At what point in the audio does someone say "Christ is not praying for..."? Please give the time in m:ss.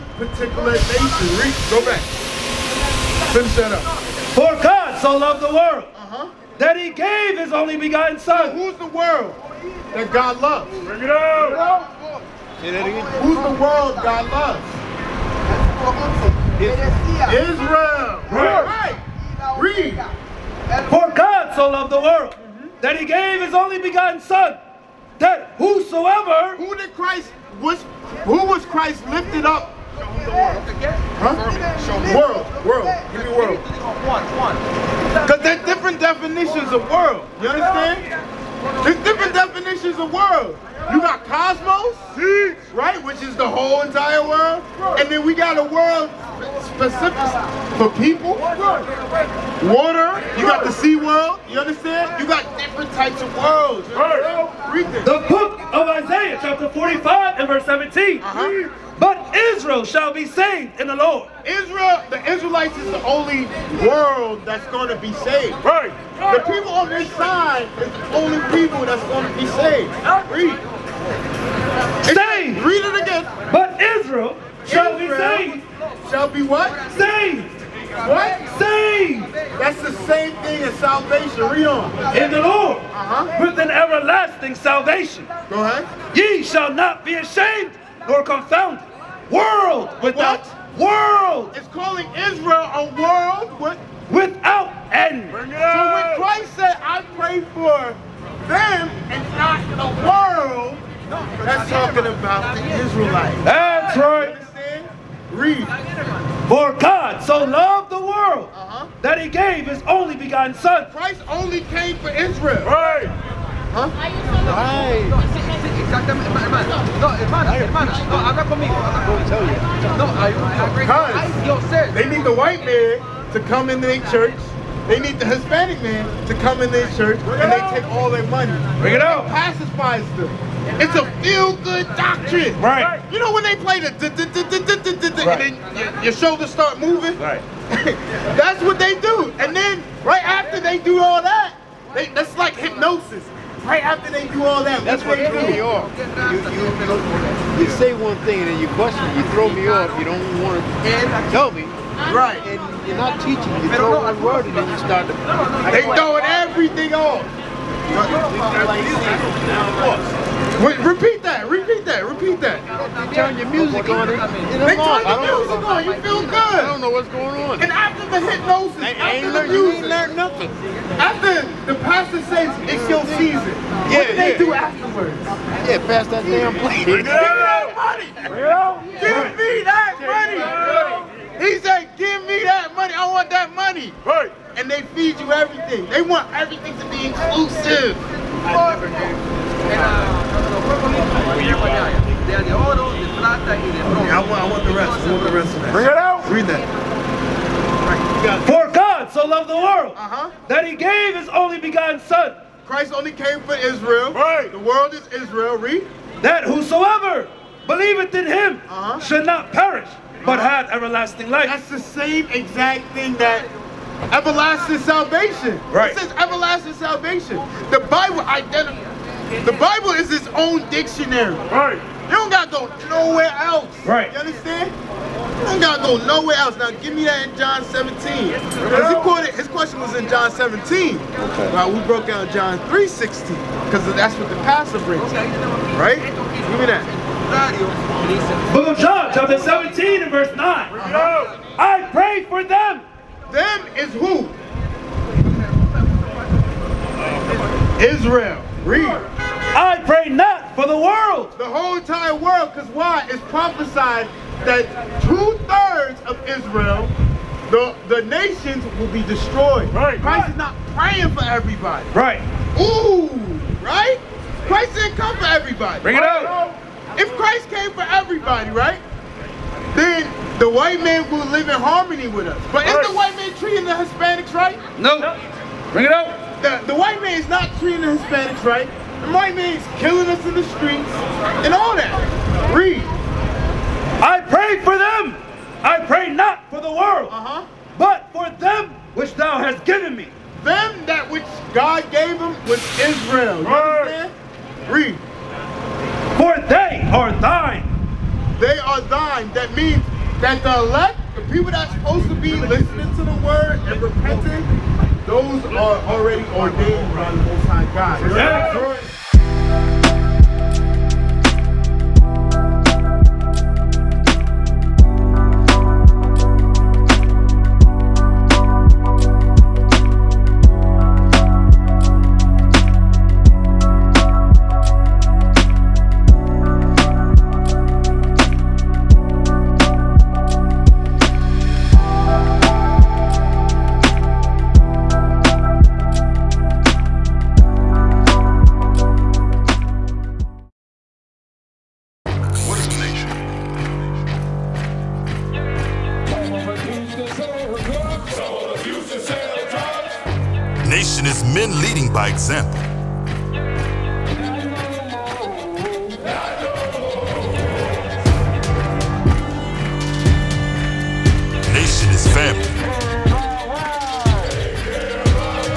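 4:19.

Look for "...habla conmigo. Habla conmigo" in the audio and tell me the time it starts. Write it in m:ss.
1:58.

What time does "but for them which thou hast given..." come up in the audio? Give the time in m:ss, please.
4:47.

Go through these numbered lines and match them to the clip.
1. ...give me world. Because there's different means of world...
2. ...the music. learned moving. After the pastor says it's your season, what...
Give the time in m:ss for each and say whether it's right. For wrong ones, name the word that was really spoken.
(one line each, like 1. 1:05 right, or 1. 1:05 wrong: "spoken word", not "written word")
1. 0:33 wrong: "definitions", not "means"
2. 2:49 wrong: "nothing", not "moving".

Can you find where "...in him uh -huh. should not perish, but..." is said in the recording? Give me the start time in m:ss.
3:28.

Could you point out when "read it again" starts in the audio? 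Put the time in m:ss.
1:12.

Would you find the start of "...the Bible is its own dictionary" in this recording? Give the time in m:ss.
3:39.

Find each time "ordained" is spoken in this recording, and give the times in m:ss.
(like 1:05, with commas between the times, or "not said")
5:06.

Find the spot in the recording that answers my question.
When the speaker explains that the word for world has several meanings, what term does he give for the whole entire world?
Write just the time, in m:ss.
0:41.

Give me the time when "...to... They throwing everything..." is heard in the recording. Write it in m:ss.
2:35.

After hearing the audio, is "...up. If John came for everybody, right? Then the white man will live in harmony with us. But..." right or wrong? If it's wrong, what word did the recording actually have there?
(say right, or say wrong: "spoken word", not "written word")
wrong: "Christ", not "John".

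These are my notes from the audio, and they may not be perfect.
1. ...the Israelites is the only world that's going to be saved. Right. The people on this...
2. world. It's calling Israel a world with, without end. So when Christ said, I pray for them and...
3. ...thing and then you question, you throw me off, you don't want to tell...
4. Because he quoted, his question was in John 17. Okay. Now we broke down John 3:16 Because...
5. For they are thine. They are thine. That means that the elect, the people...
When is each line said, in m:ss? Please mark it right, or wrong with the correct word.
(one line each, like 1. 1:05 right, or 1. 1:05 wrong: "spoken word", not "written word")
1. 1:02 right
2. 1:31 right
3. 2:28 right
4. 3:47 right
5. 4:56 right.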